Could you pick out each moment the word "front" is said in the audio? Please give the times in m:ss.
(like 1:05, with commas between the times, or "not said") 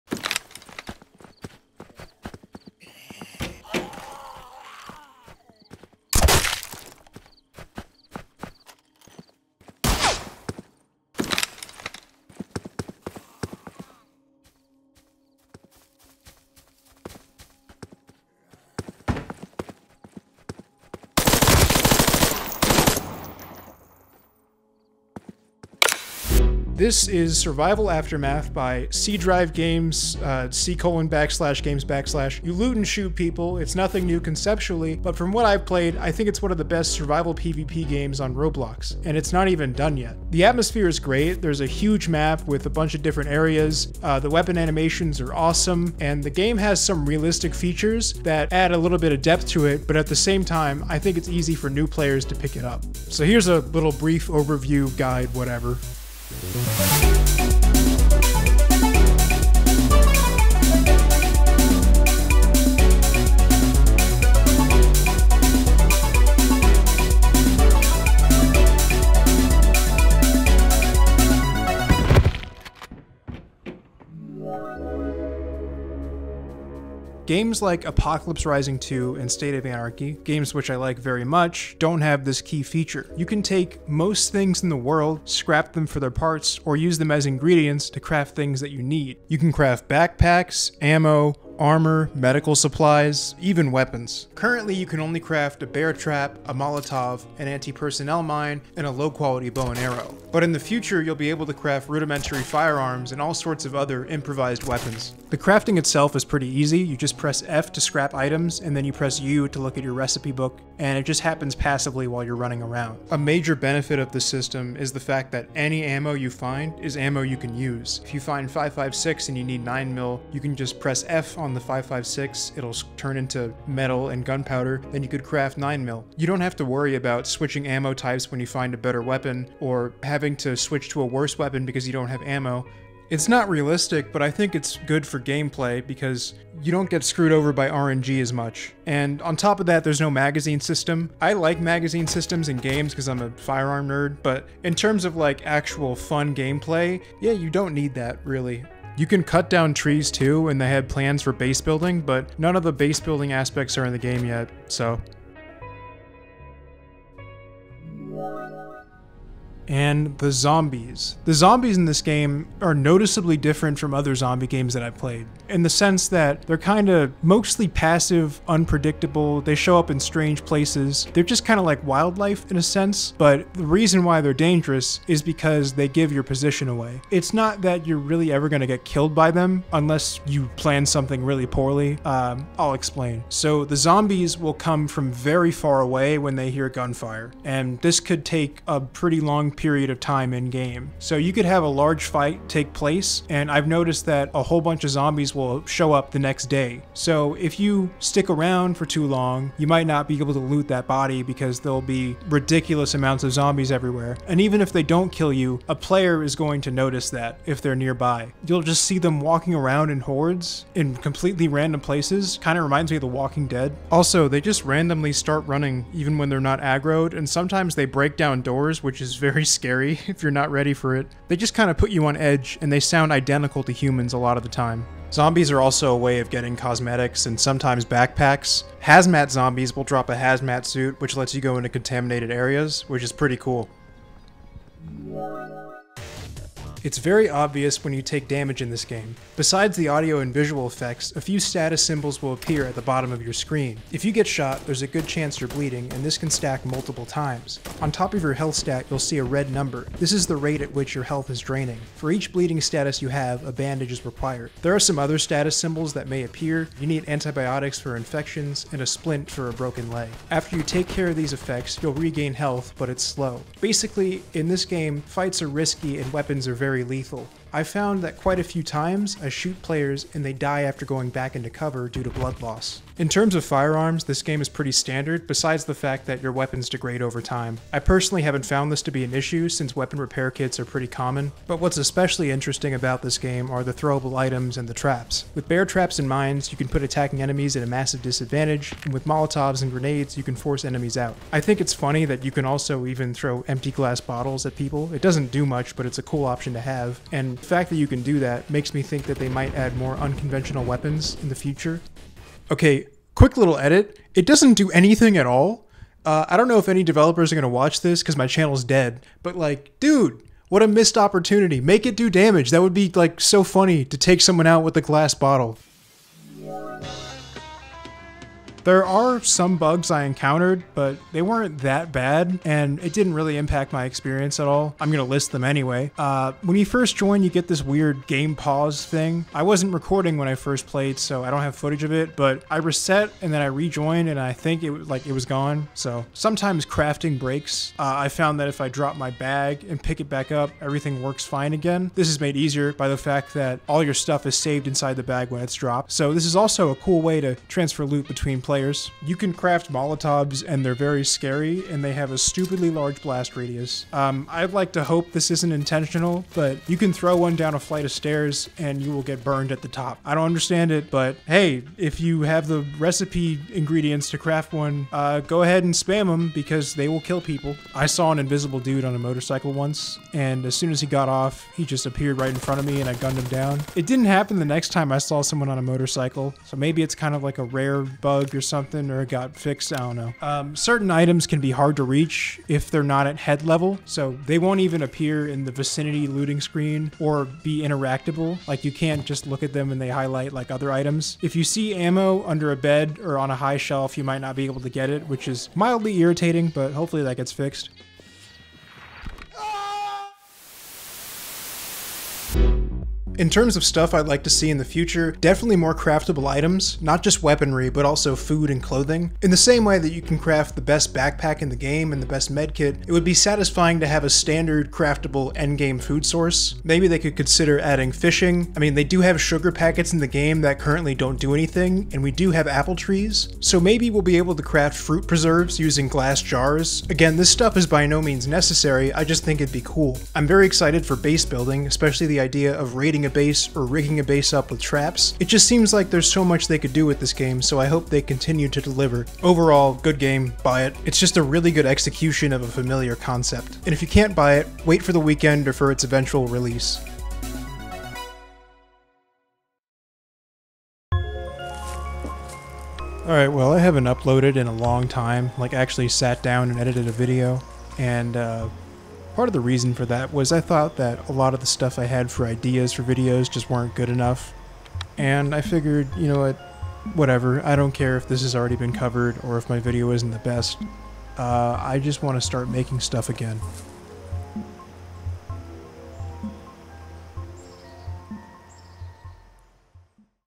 6:12.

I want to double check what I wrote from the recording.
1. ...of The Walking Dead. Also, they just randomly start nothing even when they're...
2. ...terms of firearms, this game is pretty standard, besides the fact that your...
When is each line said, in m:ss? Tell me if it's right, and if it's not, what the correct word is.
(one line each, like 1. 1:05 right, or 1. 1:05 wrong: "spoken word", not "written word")
1. 3:32 wrong: "running", not "nothing"
2. 4:33 right.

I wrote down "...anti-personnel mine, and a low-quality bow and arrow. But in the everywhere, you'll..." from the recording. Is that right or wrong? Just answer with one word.
wrong.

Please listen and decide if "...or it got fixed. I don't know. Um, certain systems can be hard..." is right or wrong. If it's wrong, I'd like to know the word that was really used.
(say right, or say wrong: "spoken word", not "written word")
wrong: "items", not "systems".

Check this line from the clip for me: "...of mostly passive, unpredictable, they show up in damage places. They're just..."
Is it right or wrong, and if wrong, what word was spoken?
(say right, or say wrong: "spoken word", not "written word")
wrong: "strange", not "damage".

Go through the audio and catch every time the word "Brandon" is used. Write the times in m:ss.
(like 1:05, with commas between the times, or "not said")
not said.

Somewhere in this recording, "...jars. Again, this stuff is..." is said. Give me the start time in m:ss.
7:06.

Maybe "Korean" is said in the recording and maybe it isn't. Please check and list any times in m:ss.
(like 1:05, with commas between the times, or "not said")
not said.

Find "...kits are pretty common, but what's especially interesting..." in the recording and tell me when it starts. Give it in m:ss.
4:40.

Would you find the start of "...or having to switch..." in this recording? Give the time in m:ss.
2:09.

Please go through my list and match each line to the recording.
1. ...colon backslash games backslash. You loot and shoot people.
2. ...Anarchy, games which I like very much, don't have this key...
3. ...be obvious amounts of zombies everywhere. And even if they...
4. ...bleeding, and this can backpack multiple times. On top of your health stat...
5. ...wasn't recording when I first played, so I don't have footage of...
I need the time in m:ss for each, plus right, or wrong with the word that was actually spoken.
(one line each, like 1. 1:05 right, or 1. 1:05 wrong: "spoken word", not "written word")
1. 0:30 right
2. 1:19 right
3. 3:21 wrong: "ridiculous", not "obvious"
4. 4:05 wrong: "stack", not "backpack"
5. 5:29 right.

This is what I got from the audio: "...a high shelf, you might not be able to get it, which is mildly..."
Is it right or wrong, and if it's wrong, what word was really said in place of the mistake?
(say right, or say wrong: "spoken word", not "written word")
right.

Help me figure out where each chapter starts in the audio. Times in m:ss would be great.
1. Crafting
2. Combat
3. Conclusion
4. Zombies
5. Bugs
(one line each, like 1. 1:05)
1. 1:15
2. 3:55
3. 6:40
4. 2:38
5. 5:17.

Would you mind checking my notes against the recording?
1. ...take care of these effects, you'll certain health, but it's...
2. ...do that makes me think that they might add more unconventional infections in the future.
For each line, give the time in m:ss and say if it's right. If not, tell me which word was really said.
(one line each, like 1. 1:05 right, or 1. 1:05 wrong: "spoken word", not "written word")
1. 4:20 wrong: "regain", not "certain"
2. 4:58 wrong: "weapons", not "infections".